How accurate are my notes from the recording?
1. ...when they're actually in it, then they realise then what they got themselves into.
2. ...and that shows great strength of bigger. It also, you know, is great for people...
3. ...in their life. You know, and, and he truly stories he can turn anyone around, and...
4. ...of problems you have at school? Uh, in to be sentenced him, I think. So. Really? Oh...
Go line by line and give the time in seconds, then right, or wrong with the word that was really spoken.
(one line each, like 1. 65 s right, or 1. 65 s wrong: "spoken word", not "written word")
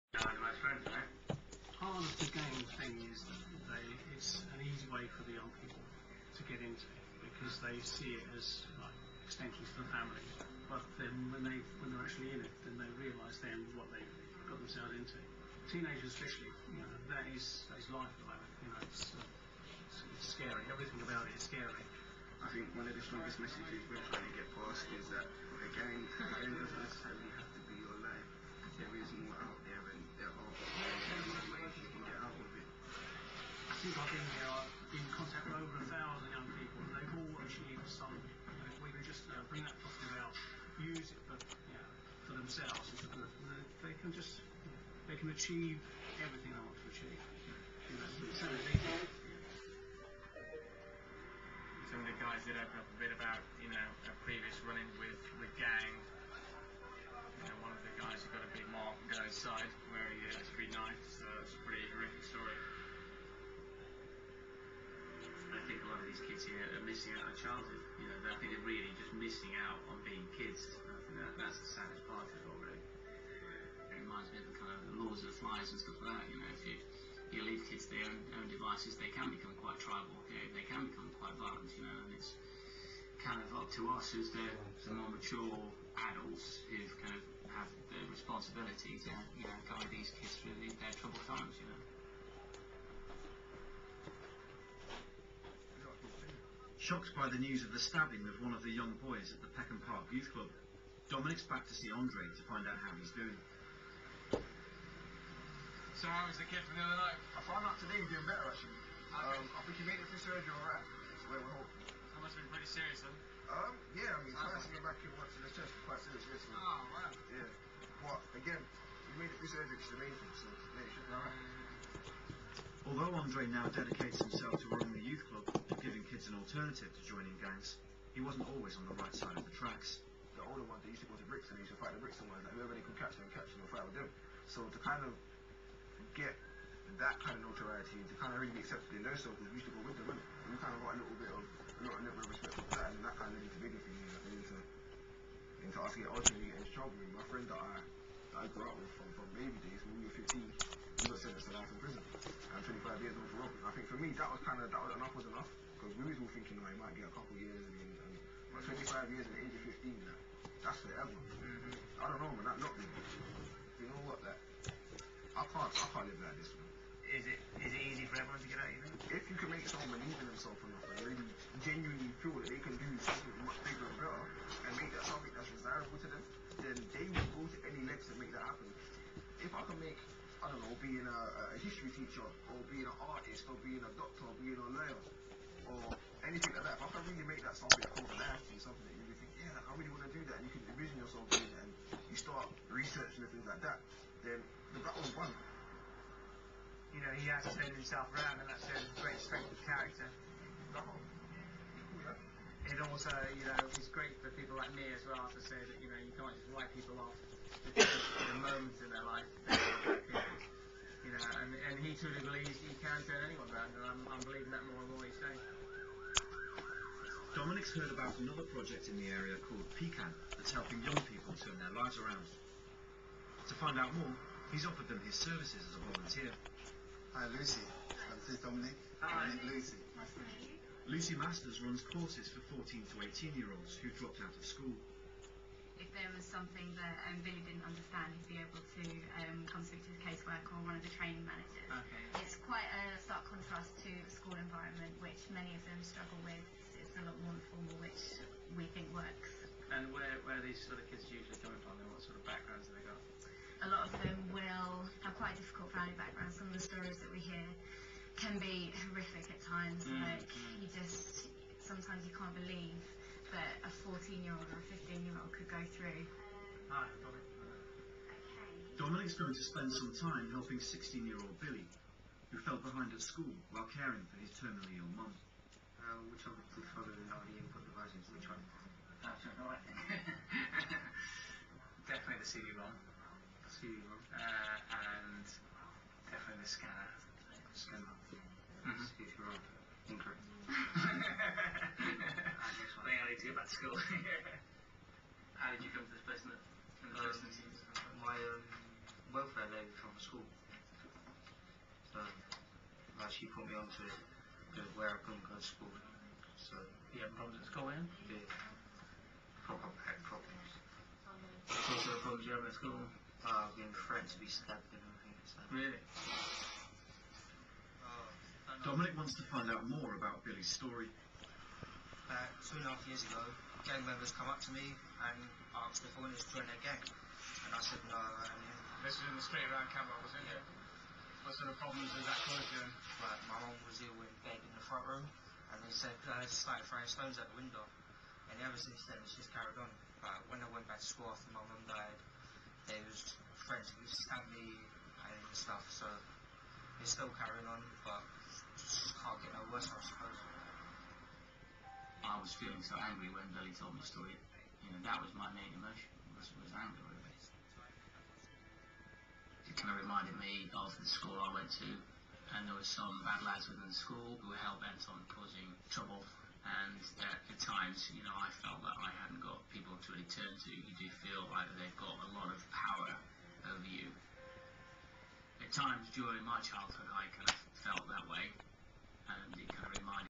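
1. 11 s right
2. 198 s wrong: "character", not "bigger"
3. 208 s wrong: "believes", not "stories"
4. 311 s wrong: "stabbed", not "sentenced".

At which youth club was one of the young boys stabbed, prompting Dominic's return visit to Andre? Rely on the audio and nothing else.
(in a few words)
Peckham Park Youth Club.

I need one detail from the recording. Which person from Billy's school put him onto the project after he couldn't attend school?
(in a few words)
Welfare lady.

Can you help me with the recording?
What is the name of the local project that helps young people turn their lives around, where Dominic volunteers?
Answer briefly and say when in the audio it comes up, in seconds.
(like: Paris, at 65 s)
Pecan, at 219 s.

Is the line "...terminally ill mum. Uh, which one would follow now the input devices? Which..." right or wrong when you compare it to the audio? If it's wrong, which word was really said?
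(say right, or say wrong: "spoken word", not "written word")
right.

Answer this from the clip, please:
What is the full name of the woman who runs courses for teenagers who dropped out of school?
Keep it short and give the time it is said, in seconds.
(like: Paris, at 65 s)
Lucy Masters, at 230 s.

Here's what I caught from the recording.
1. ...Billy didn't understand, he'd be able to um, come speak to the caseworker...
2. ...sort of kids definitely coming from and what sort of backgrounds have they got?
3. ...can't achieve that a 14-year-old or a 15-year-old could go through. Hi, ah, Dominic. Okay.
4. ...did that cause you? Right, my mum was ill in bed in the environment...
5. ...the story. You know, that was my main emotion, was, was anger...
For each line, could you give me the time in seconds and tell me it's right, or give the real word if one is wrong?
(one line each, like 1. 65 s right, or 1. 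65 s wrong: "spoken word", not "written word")
1. 237 s right
2. 250 s wrong: "usually", not "definitely"
3. 262 s wrong: "believe", not "achieve"
4. 331 s wrong: "front", not "environment"
5. 353 s right.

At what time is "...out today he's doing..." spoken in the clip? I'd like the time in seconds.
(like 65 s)
107 s.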